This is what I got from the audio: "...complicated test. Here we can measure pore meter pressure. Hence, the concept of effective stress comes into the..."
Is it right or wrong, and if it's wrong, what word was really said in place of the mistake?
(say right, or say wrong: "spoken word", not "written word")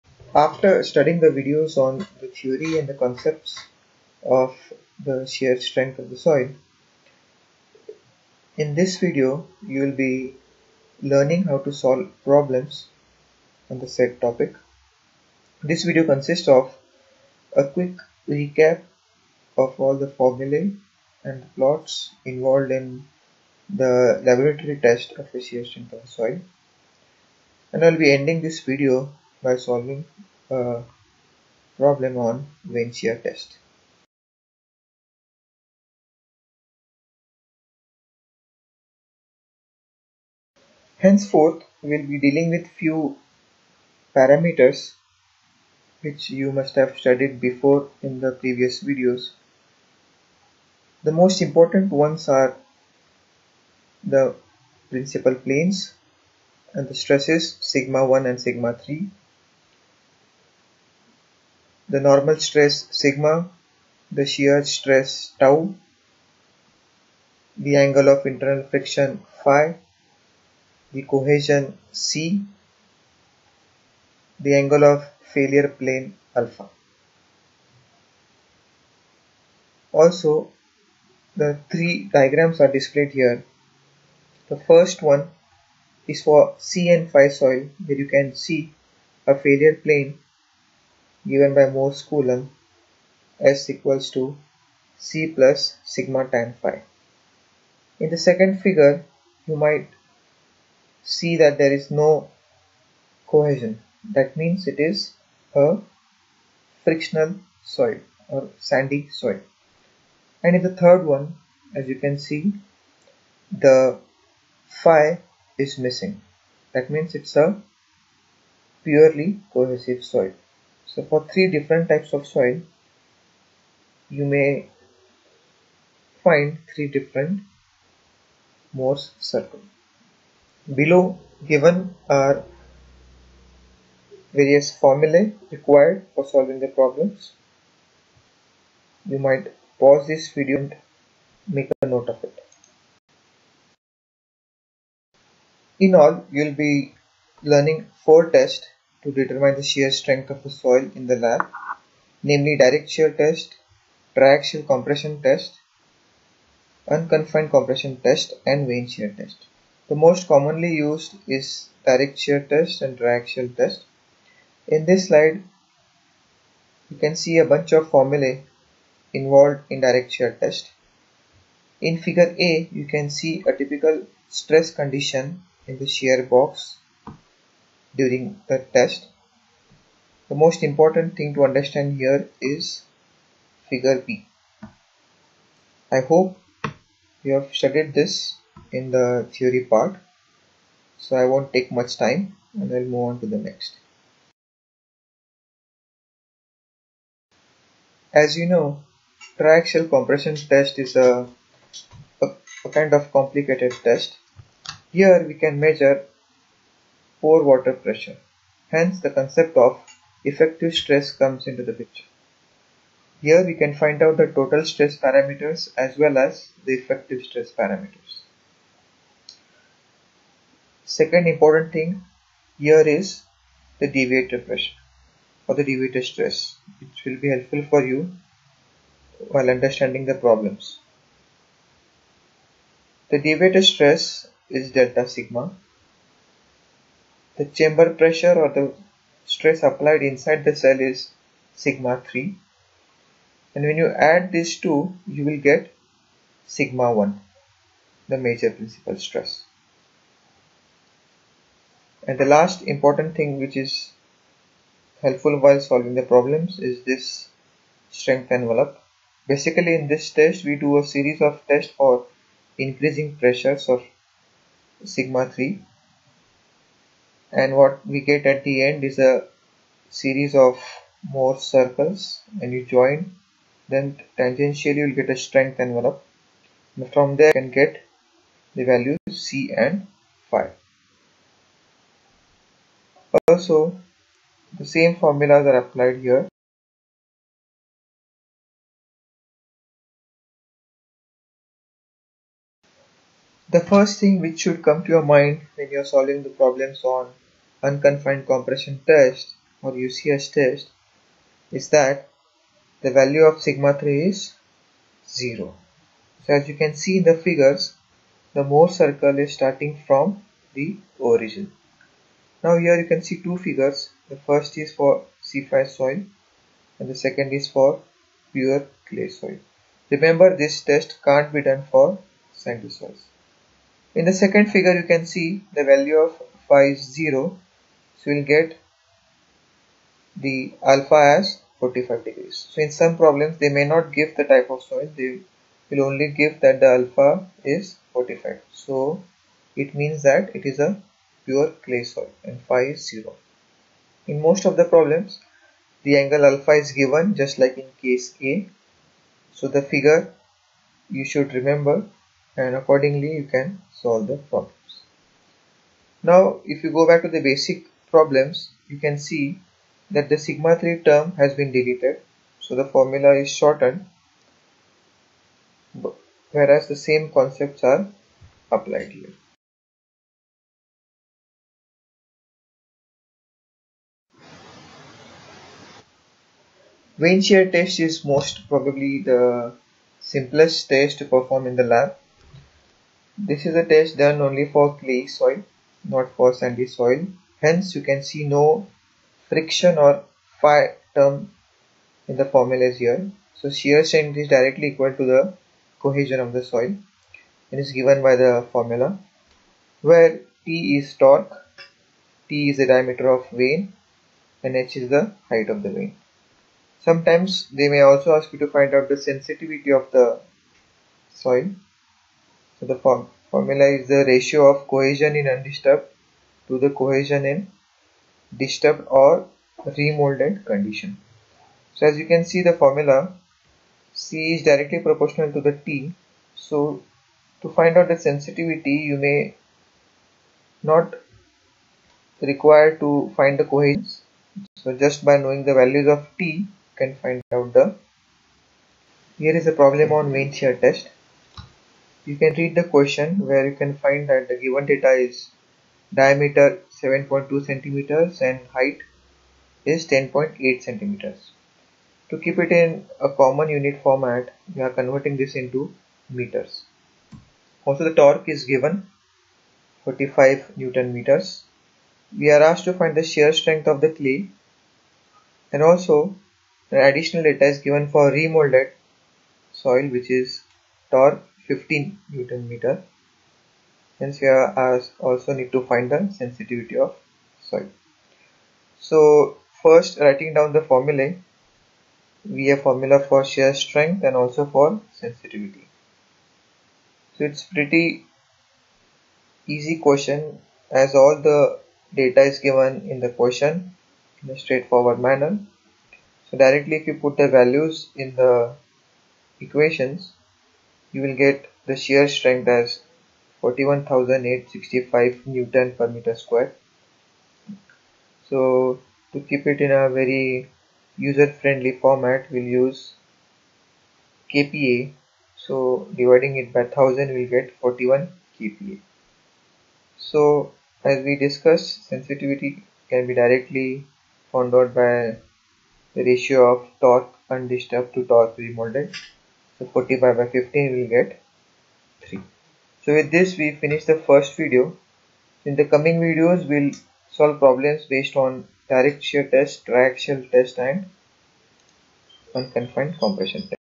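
wrong: "water", not "meter".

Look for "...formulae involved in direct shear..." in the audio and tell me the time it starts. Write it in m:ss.
2:47.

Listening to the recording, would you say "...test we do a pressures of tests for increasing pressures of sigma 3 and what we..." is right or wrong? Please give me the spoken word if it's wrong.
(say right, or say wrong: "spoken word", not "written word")
wrong: "series", not "pressures".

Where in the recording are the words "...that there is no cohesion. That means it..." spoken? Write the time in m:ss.
1:41.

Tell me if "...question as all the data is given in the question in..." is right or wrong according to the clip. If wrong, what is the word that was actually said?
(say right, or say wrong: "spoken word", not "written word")
right.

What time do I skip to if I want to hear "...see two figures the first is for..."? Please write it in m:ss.
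5:13.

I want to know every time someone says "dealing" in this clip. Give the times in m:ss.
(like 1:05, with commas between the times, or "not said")
0:42.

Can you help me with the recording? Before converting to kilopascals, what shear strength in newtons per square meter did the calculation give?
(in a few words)
41,865.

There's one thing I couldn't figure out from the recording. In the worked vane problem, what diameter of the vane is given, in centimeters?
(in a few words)
7.2 centimeters.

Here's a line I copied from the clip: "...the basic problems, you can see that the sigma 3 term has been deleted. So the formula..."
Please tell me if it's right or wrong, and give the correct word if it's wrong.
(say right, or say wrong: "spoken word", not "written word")
right.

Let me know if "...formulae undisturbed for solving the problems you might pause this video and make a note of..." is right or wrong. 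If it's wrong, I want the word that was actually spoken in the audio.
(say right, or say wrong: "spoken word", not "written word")
wrong: "required", not "undisturbed".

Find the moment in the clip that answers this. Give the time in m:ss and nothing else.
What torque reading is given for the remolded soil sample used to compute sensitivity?
7:51.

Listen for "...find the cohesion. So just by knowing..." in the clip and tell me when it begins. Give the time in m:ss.
7:13.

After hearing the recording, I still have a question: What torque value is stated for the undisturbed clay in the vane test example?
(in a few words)
45 newton meters.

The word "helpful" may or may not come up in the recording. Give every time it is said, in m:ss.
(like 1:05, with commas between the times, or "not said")
3:47, 4:15.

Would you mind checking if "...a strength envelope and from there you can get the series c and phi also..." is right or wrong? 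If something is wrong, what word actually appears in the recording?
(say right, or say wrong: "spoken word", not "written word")
wrong: "values", not "series".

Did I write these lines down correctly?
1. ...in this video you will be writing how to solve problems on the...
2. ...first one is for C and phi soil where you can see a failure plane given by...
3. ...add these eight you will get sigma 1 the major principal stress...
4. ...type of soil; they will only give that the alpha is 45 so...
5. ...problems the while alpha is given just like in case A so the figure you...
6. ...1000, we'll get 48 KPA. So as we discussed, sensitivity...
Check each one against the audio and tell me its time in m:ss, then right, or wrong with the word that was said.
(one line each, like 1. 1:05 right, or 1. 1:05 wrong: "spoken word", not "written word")
1. 0:08 wrong: "learning", not "writing"
2. 1:24 right
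3. 4:03 wrong: "two", not "eight"
4. 5:34 right
5. 5:44 wrong: "angle", not "while"
6. 8:36 wrong: "41", not "48".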